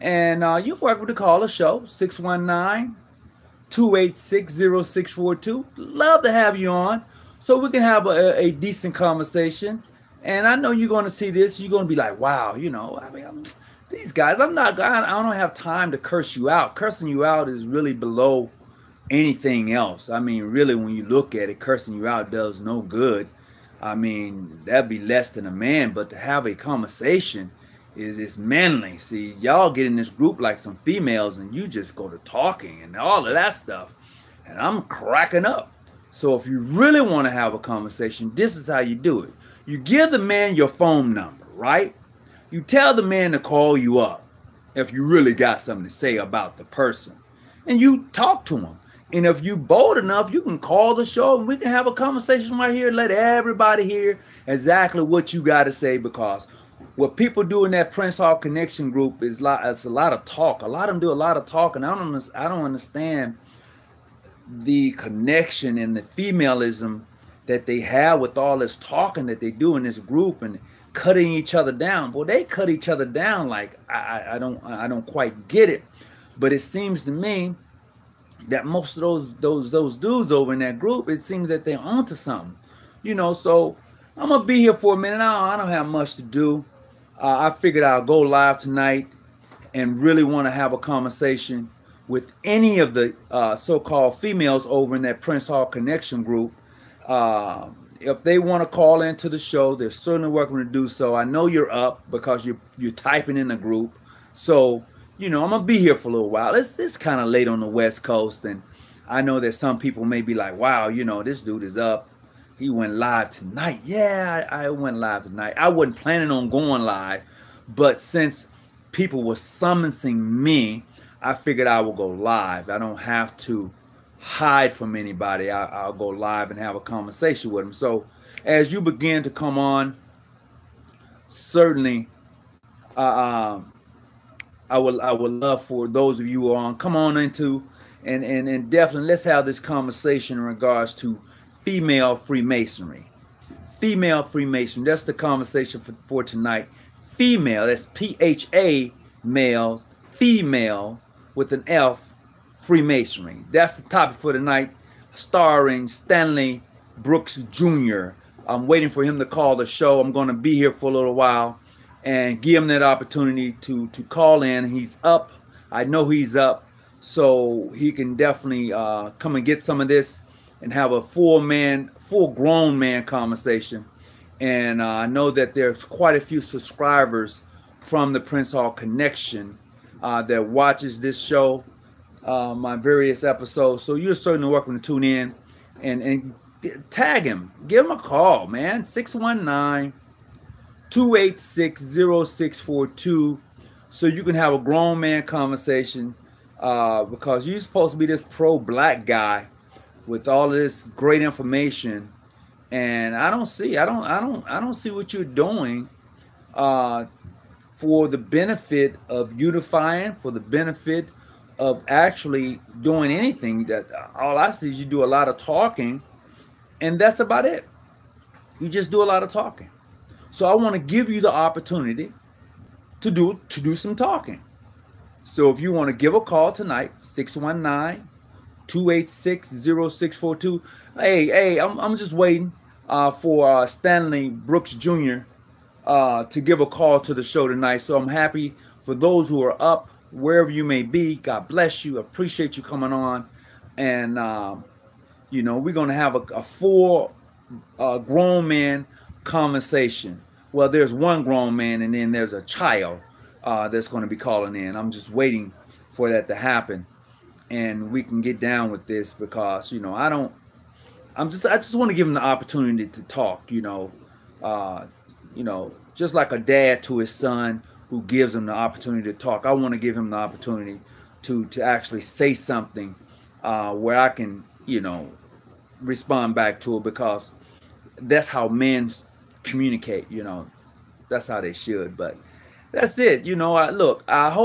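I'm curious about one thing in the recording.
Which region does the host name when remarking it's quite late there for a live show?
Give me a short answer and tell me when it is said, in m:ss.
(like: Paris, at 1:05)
West Coast, at 1:47.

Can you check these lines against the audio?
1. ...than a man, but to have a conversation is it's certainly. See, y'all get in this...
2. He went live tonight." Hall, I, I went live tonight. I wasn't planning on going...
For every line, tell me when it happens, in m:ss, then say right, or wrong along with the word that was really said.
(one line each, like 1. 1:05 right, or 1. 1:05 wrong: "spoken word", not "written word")
1. 0:25 wrong: "manly", not "certainly"
2. 1:52 wrong: "Yeah", not "Hall".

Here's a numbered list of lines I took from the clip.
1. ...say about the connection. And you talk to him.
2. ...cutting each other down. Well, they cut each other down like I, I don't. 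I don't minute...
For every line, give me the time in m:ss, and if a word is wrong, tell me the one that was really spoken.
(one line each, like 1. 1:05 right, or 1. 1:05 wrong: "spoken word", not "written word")
1. 0:45 wrong: "person", not "connection"
2. 1:10 wrong: "quite", not "minute".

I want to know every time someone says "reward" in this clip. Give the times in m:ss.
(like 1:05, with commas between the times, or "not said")
not said.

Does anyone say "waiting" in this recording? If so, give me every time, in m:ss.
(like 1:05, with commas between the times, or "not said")
2:38, 3:52, 4:15.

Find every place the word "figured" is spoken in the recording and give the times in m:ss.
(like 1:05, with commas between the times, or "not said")
1:27, 2:01.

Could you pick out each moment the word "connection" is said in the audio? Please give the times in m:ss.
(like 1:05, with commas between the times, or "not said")
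0:58, 1:04, 1:35, 2:58.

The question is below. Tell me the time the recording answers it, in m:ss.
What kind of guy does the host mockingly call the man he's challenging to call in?
3:18.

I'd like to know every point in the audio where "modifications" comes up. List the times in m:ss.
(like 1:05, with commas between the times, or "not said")
not said.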